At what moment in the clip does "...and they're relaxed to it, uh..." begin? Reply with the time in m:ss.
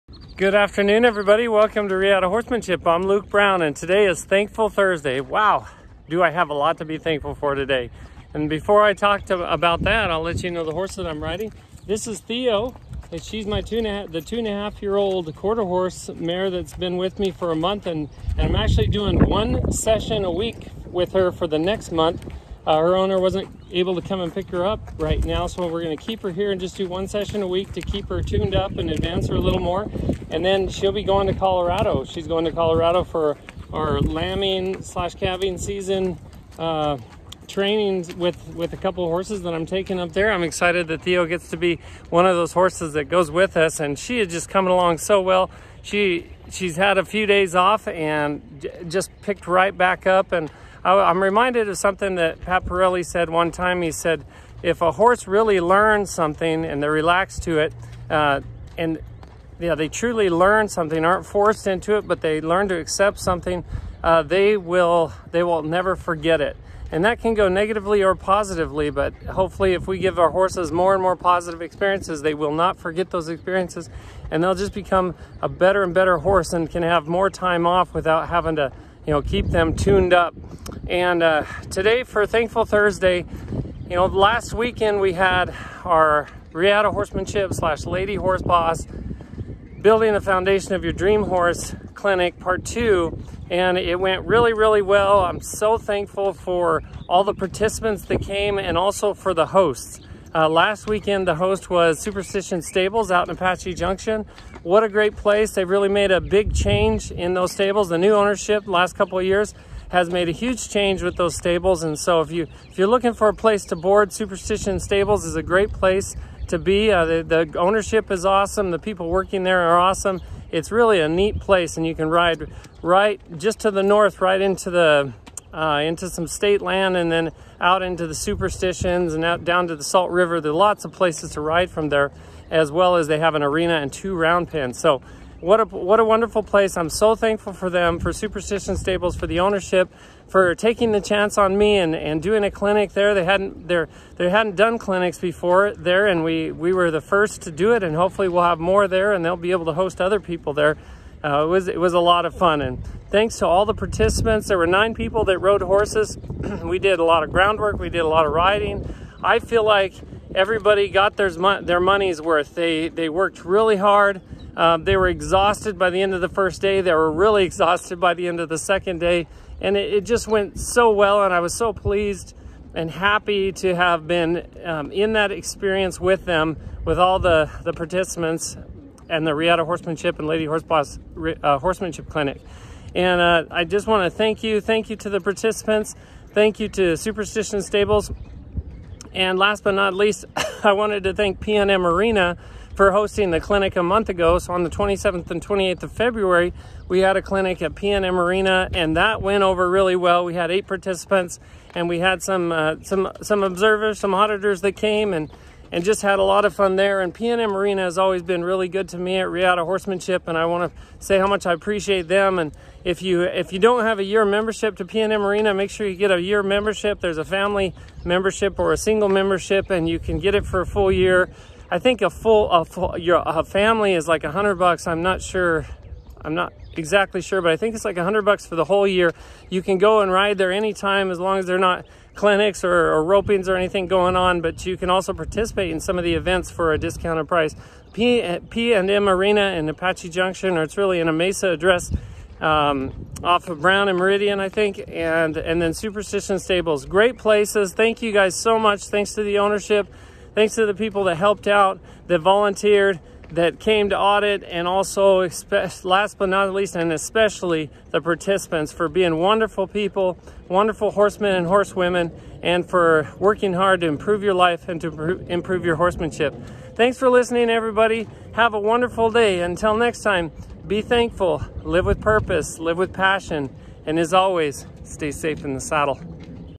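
0:56.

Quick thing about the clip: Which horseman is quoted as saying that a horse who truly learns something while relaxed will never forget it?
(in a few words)
Pat Parelli.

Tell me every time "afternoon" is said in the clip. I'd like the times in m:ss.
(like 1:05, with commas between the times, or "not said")
0:00.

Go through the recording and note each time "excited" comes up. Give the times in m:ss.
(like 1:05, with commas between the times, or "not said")
0:40.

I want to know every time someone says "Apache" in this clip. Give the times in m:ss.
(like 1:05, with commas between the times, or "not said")
1:43, 3:59.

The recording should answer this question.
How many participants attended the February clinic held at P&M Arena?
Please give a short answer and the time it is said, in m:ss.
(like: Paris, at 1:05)
8, at 3:20.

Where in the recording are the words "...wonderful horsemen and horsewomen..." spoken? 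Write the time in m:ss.
4:20.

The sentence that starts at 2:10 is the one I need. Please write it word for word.
There are lots of places to ride from there, as well as they have an arena and two round pens.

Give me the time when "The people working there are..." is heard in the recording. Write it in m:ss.
1:58.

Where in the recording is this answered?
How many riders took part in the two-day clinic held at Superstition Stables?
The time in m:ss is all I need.
2:34.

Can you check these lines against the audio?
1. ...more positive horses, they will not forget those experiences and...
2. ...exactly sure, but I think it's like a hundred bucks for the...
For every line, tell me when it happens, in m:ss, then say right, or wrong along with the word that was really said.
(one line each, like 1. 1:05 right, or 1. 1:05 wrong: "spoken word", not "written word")
1. 1:11 wrong: "experiences", not "horses"
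2. 3:46 right.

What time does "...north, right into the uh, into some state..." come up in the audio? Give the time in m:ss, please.
2:03.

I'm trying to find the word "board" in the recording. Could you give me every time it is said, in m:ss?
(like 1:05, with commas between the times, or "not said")
1:53.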